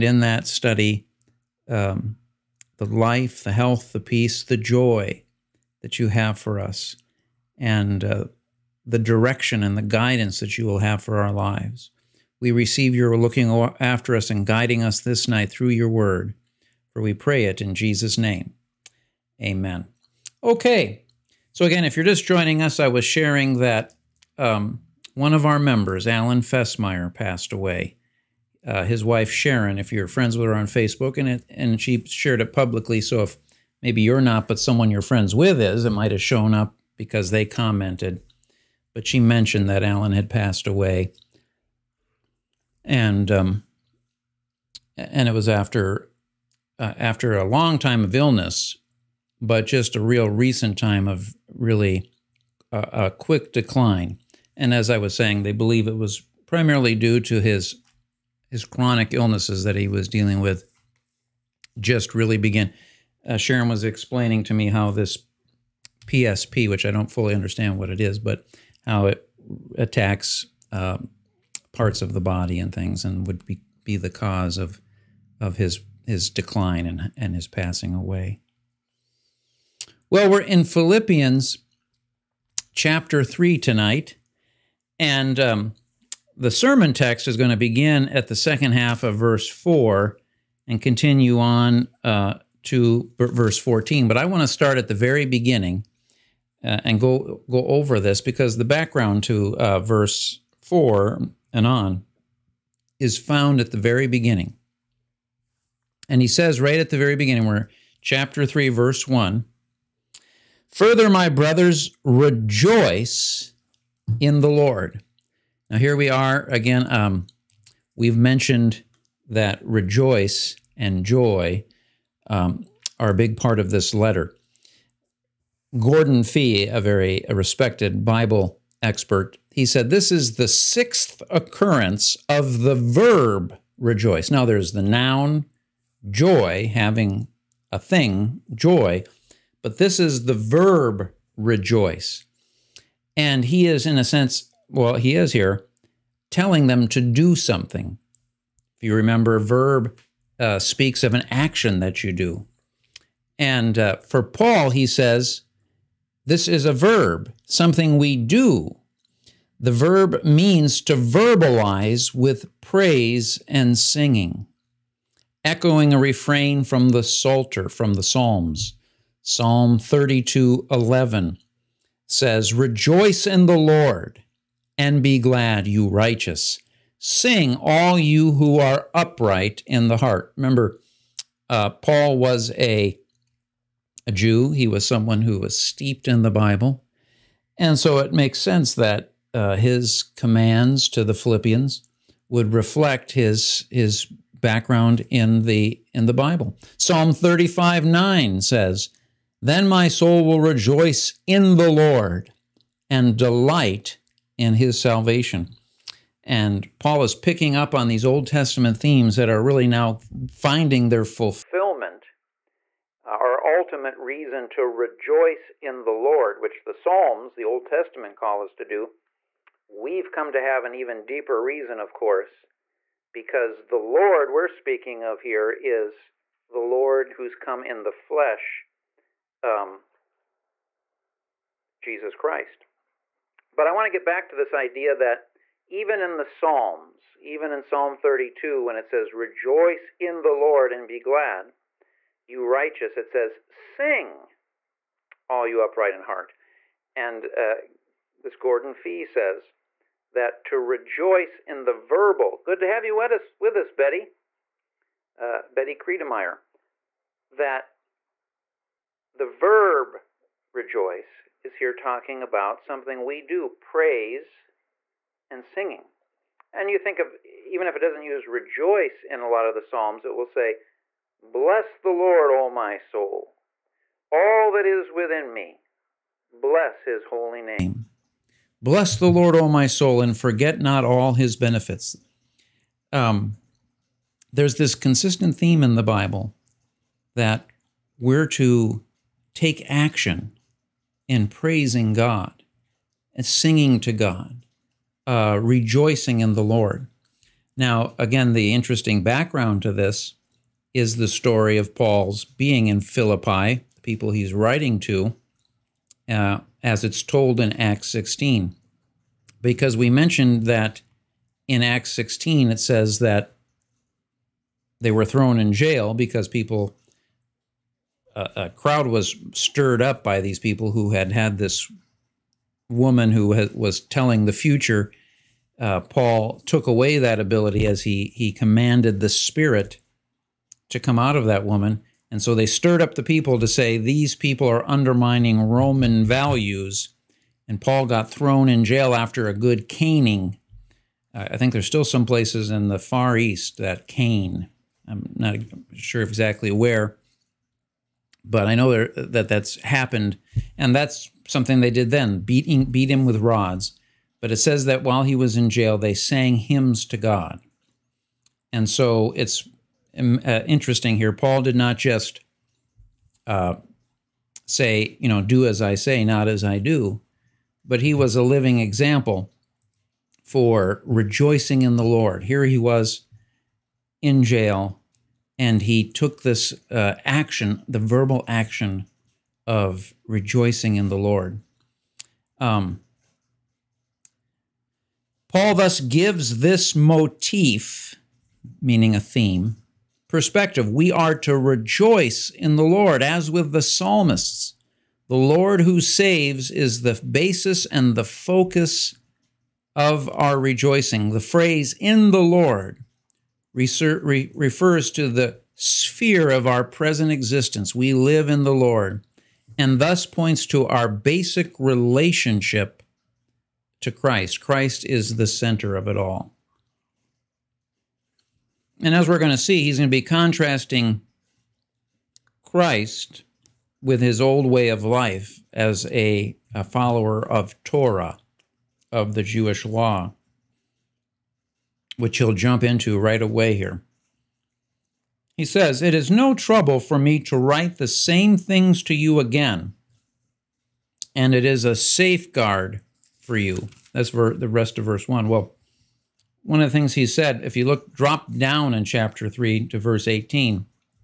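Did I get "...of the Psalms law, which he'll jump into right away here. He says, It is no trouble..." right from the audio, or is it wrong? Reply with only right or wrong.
wrong.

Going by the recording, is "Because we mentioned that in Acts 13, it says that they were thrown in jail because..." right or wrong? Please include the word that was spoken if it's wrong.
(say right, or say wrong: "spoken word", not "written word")
wrong: "16", not "13".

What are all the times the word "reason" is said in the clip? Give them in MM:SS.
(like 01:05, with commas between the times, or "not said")
03:33, 03:41.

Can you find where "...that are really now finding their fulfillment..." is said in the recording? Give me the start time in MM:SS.
03:29.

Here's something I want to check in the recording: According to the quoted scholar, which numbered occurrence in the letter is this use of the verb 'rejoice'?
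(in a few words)
sixth.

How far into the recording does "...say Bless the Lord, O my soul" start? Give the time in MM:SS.
04:30.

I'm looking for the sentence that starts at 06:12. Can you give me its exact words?
Here he was in jail, and he took this uh, action, the verbal action of rejoicing in the Lord.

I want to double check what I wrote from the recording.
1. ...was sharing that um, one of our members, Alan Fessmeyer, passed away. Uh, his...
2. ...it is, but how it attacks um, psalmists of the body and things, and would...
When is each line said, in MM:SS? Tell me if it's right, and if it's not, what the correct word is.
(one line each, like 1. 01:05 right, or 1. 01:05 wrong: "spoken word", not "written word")
1. 00:22 right
2. 01:07 wrong: "parts", not "psalmists".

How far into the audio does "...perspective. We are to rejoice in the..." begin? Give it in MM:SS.
06:30.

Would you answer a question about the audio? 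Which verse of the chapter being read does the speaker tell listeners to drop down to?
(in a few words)
verse 18.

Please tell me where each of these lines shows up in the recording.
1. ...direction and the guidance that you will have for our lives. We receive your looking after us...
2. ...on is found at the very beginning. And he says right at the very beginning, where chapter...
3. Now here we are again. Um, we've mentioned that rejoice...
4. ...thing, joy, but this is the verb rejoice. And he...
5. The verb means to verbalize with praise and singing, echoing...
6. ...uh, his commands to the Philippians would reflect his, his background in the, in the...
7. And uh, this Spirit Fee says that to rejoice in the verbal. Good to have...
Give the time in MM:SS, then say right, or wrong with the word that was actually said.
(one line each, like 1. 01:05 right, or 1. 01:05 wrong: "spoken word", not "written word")
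1. 00:08 right
2. 01:41 right
3. 01:55 right
4. 02:17 right
5. 02:39 right
6. 03:09 right
7. 04:06 wrong: "Gordon", not "Spirit".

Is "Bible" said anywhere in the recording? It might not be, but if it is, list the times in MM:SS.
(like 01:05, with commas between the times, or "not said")
02:08, 03:06, 03:16, 04:45.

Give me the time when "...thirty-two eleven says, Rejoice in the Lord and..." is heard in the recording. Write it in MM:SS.
02:49.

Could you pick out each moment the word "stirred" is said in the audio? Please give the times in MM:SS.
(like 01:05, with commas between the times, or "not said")
05:19, 05:32.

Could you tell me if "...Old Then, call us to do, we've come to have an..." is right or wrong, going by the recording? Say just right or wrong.
wrong.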